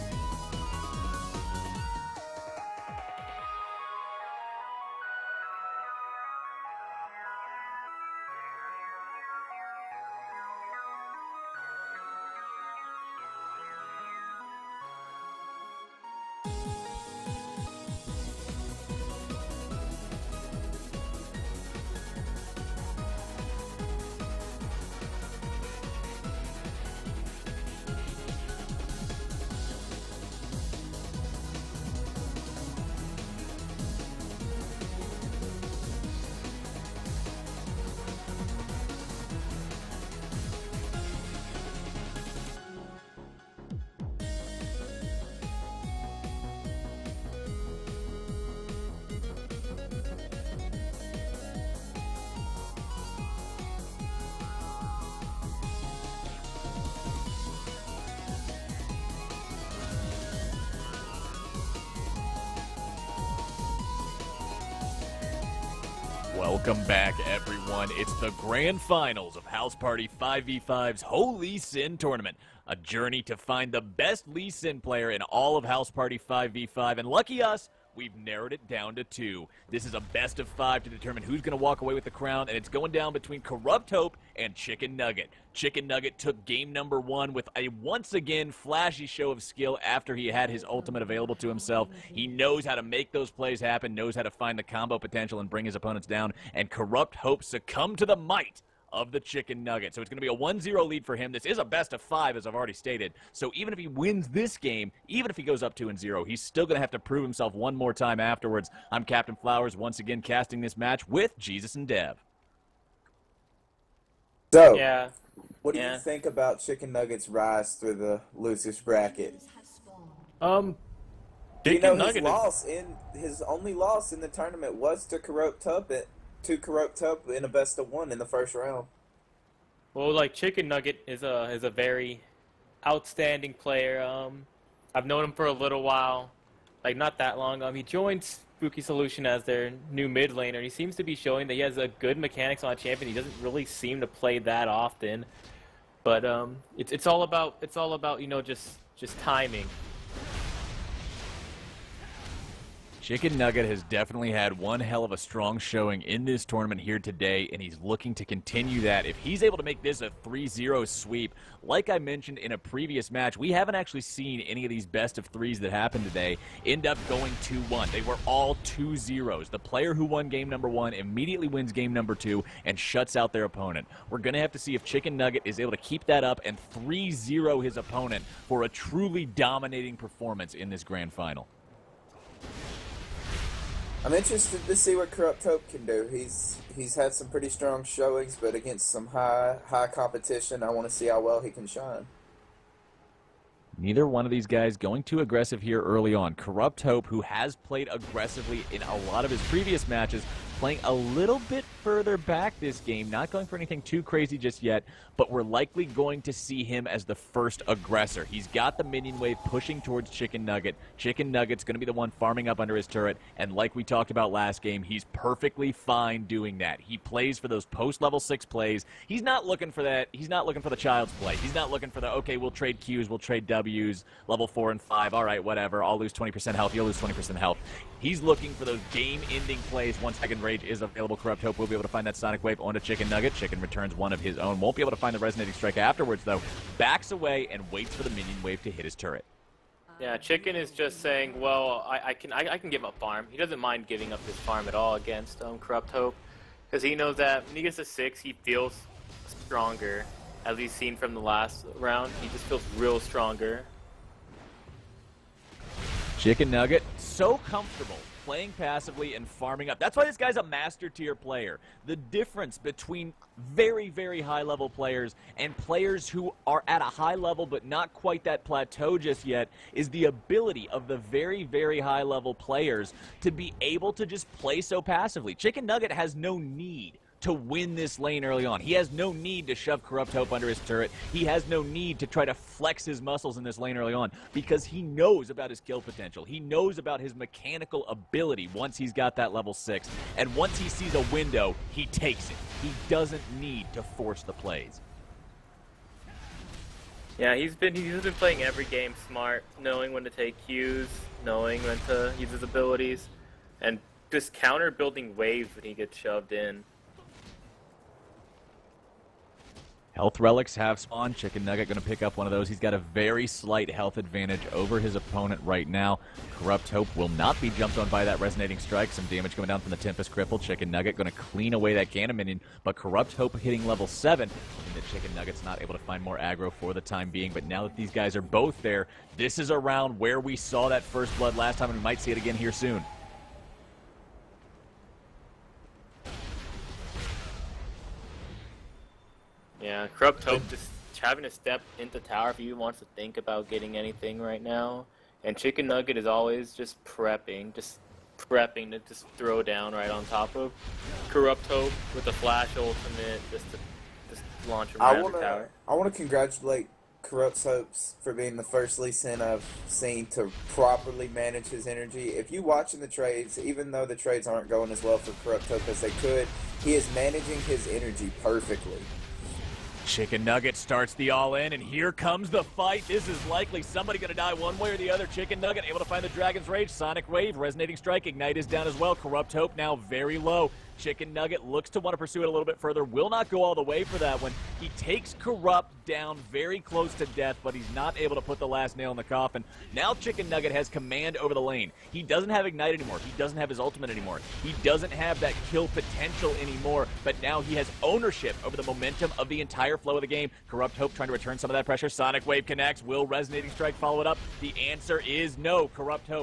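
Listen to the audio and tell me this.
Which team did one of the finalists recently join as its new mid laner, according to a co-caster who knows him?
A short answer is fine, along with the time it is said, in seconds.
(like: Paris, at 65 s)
Spooky Solution, at 138 s.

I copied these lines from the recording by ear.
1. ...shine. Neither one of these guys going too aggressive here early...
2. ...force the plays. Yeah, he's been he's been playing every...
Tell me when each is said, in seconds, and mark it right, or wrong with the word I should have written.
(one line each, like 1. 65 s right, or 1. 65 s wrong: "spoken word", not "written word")
1. 191 s right
2. 293 s right.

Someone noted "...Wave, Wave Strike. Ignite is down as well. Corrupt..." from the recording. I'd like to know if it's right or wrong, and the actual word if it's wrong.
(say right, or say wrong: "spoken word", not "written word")
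wrong: "Resonating", not "Wave".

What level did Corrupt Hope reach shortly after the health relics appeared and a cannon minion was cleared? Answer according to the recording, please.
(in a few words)
7.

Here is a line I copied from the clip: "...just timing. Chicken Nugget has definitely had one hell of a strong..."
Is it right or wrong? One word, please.
right.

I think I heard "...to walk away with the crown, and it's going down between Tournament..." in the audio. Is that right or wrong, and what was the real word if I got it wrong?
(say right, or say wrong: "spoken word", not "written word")
wrong: "Corrupt", not "Tournament".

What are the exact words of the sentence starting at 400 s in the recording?
Corrupt Hope trying to return some of that pressure.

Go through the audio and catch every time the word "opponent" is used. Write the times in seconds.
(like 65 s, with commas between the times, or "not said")
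95 s, 173 s, 177 s, 314 s.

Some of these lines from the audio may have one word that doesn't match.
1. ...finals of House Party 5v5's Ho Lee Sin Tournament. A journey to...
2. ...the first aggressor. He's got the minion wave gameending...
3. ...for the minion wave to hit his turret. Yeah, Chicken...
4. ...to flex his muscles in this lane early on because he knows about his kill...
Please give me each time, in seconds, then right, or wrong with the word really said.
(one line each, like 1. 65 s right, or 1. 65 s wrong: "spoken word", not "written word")
1. 68 s right
2. 207 s wrong: "pushing", not "gameending"
3. 237 s right
4. 282 s right.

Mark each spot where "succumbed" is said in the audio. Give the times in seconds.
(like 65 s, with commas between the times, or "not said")
97 s.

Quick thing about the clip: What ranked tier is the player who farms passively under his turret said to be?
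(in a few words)
master tier.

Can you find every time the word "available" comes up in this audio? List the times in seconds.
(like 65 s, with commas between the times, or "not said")
91 s, 230 s.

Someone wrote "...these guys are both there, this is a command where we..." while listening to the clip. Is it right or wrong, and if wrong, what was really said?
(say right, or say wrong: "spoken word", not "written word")
wrong: "round", not "command".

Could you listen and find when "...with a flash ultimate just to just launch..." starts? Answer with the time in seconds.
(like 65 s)
351 s.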